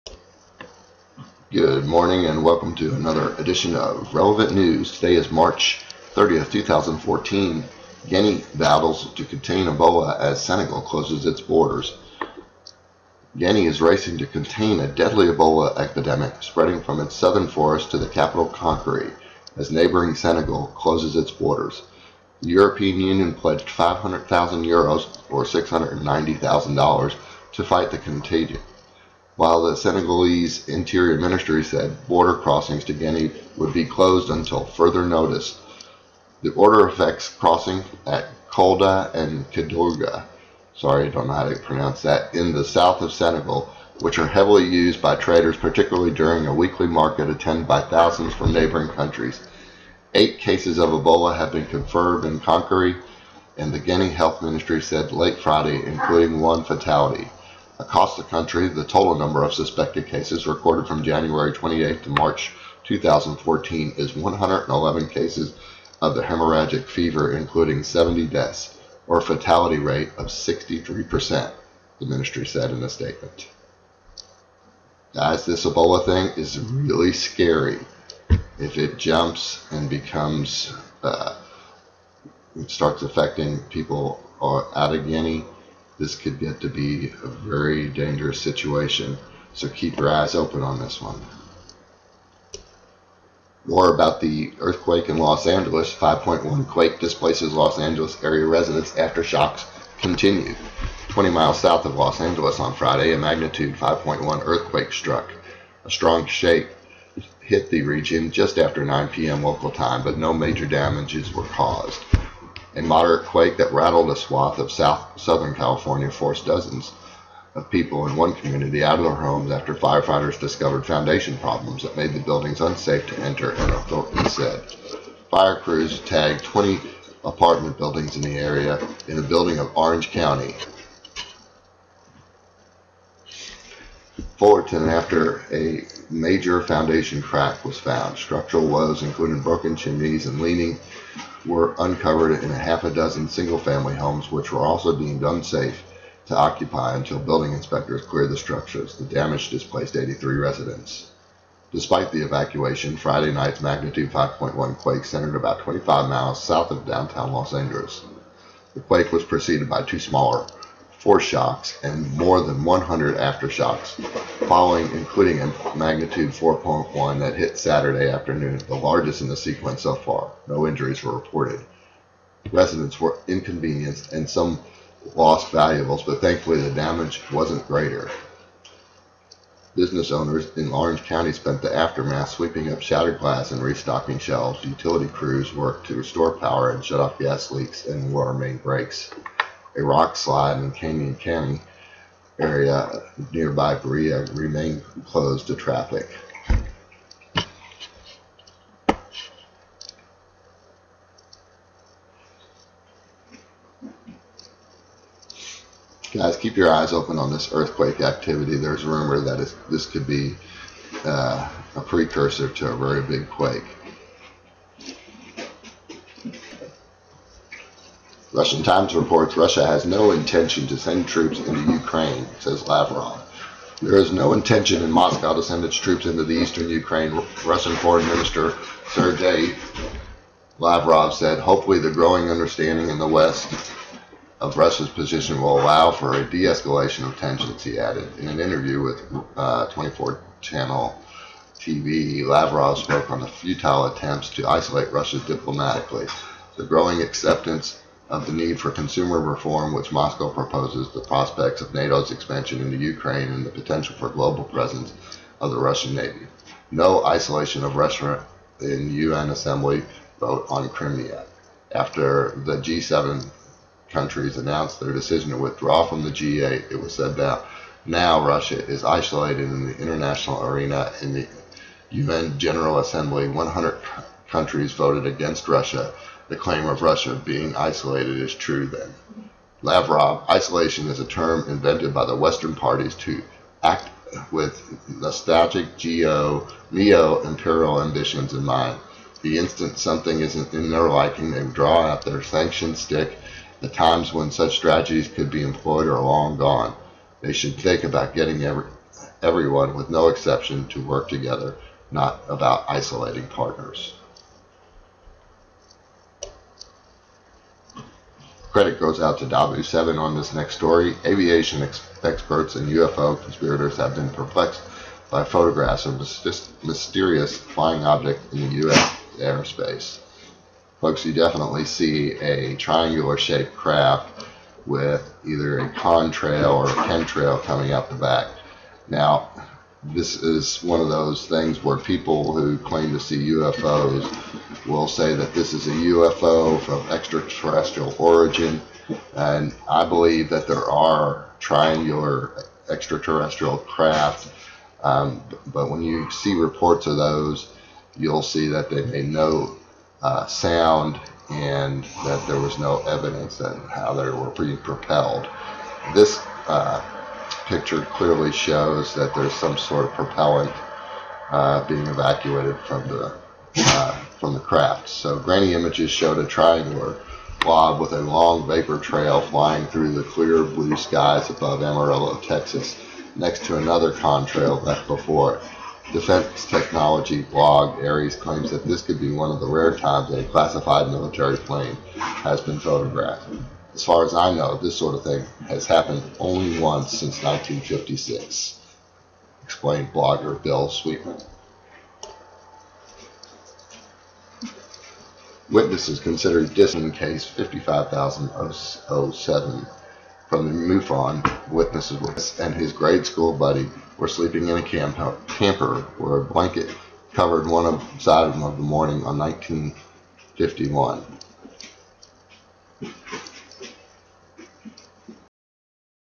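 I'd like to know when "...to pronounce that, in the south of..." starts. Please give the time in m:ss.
0:41.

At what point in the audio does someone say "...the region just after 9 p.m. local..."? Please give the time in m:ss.
1:47.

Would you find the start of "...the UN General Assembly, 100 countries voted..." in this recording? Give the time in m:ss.
4:31.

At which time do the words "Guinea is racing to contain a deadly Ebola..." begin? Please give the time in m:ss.
0:13.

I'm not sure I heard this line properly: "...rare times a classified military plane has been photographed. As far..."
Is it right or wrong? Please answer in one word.
right.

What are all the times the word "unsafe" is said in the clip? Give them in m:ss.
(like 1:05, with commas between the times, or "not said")
2:02, 2:25.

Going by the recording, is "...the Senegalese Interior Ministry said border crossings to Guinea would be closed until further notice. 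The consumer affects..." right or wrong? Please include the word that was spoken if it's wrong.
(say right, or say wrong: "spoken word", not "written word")
wrong: "order", not "consumer".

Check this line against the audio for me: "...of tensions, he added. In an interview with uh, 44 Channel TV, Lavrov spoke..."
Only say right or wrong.
wrong.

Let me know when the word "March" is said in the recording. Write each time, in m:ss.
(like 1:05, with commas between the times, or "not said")
0:05, 1:02.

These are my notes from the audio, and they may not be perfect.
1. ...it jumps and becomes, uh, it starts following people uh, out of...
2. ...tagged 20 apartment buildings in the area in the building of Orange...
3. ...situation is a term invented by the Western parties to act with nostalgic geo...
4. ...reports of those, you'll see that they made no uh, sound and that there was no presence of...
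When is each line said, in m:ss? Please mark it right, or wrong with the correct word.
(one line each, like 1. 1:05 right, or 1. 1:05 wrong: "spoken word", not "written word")
1. 1:18 wrong: "affecting", not "following"
2. 2:05 right
3. 4:40 wrong: "isolation", not "situation"
4. 5:46 wrong: "evidence", not "presence".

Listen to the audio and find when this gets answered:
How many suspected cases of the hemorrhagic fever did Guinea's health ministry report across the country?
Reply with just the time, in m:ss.
1:04.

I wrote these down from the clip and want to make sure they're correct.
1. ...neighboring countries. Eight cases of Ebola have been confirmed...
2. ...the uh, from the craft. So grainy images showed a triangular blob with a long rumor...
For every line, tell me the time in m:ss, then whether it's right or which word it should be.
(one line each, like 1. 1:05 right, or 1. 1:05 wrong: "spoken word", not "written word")
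1. 0:48 right
2. 6:02 wrong: "vapor", not "rumor".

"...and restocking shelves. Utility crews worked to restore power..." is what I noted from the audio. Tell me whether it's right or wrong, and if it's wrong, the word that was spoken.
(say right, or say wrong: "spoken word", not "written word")
right.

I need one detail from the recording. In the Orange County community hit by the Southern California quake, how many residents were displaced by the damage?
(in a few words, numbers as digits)
83.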